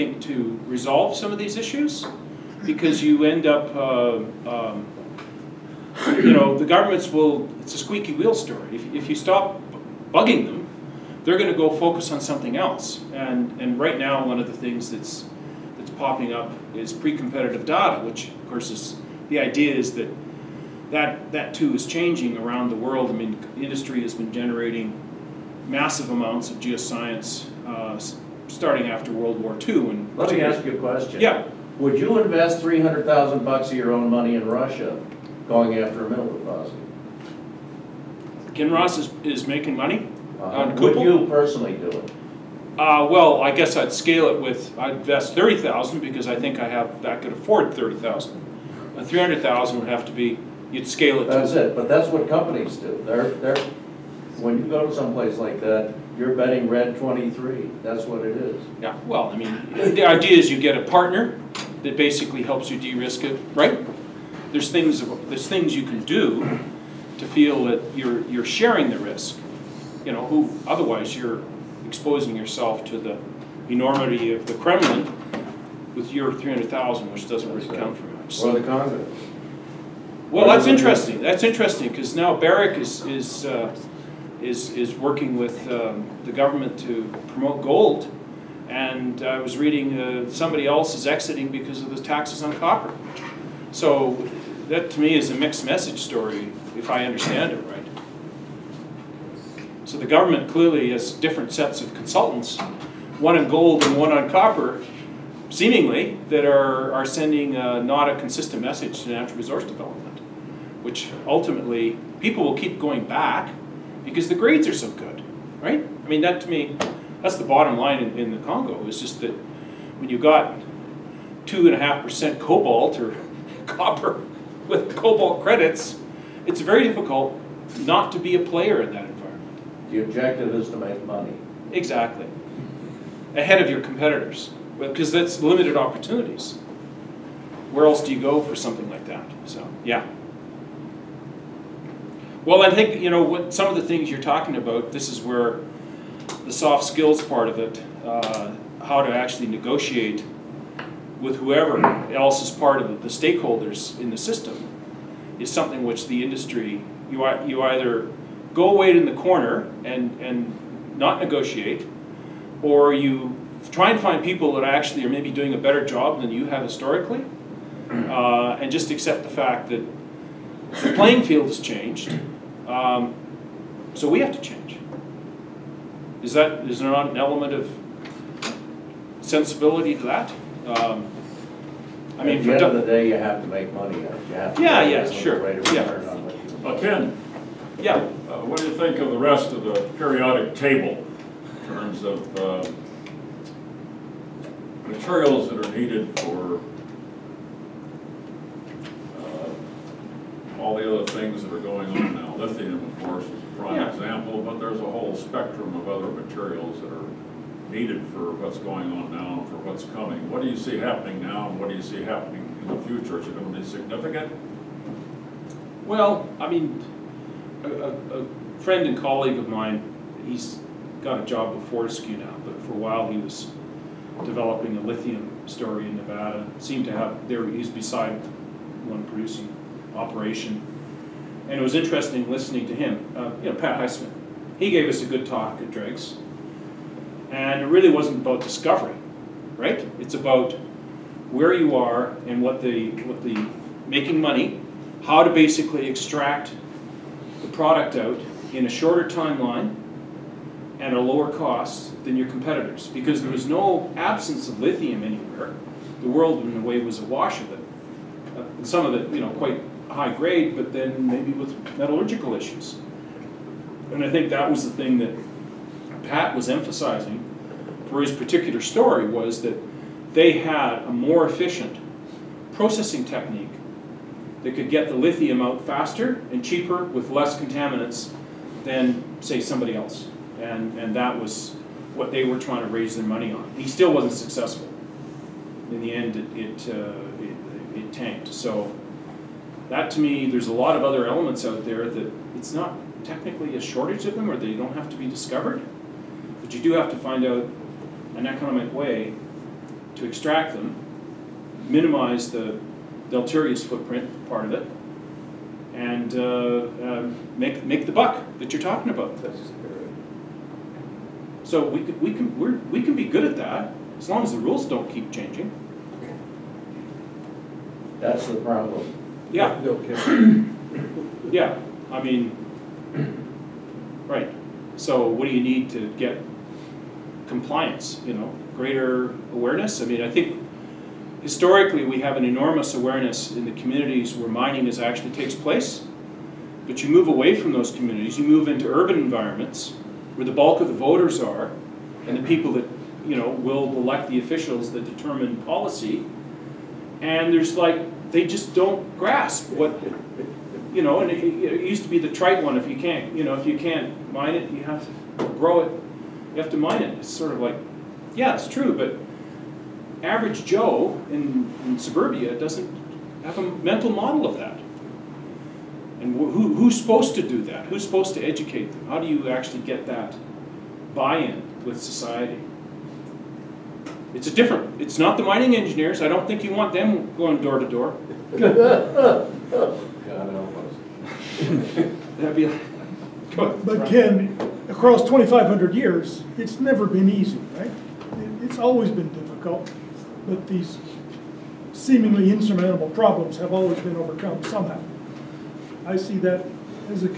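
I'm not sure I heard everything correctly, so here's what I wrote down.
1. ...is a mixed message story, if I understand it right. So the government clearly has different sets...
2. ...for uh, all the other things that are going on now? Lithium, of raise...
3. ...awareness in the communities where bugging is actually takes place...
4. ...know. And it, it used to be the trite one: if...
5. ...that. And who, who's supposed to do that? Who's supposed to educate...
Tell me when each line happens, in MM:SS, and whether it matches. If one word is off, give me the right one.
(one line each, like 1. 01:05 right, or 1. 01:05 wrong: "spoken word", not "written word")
1. 01:35 right
2. 03:16 wrong: "course", not "raise"
3. 05:32 wrong: "mining", not "bugging"
4. 05:50 right
5. 06:04 right.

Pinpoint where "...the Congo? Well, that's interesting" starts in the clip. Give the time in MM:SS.
01:18.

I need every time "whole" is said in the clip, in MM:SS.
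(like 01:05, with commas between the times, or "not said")
03:24.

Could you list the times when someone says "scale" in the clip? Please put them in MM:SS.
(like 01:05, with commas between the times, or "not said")
00:43, 00:50.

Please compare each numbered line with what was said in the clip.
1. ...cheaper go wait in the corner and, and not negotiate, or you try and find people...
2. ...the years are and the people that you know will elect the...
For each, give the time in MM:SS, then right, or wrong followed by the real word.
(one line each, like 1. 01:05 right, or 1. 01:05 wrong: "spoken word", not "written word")
1. 02:37 wrong: "either", not "cheaper"
2. 05:40 wrong: "voters", not "years".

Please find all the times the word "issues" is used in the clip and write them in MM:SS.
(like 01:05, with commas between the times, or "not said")
00:01, 04:22.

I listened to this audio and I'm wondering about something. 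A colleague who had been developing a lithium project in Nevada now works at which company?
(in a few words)
Fortescue.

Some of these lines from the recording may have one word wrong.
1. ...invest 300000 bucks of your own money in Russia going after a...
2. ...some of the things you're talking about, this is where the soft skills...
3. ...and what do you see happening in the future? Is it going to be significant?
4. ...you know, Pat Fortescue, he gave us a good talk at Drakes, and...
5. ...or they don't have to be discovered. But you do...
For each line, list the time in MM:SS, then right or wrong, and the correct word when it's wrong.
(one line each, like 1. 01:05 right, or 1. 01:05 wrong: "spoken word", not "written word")
1. 00:32 right
2. 02:23 right
3. 03:31 right
4. 03:53 wrong: "Heisman", not "Fortescue"
5. 04:54 right.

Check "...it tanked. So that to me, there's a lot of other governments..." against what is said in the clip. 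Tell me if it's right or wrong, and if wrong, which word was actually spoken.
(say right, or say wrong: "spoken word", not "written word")
wrong: "elements", not "governments".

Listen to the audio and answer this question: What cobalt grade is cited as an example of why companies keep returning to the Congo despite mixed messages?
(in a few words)
2.5%.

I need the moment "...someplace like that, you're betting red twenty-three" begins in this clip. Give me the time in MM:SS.
00:54.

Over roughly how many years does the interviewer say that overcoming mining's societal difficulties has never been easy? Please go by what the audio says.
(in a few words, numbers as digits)
2,500.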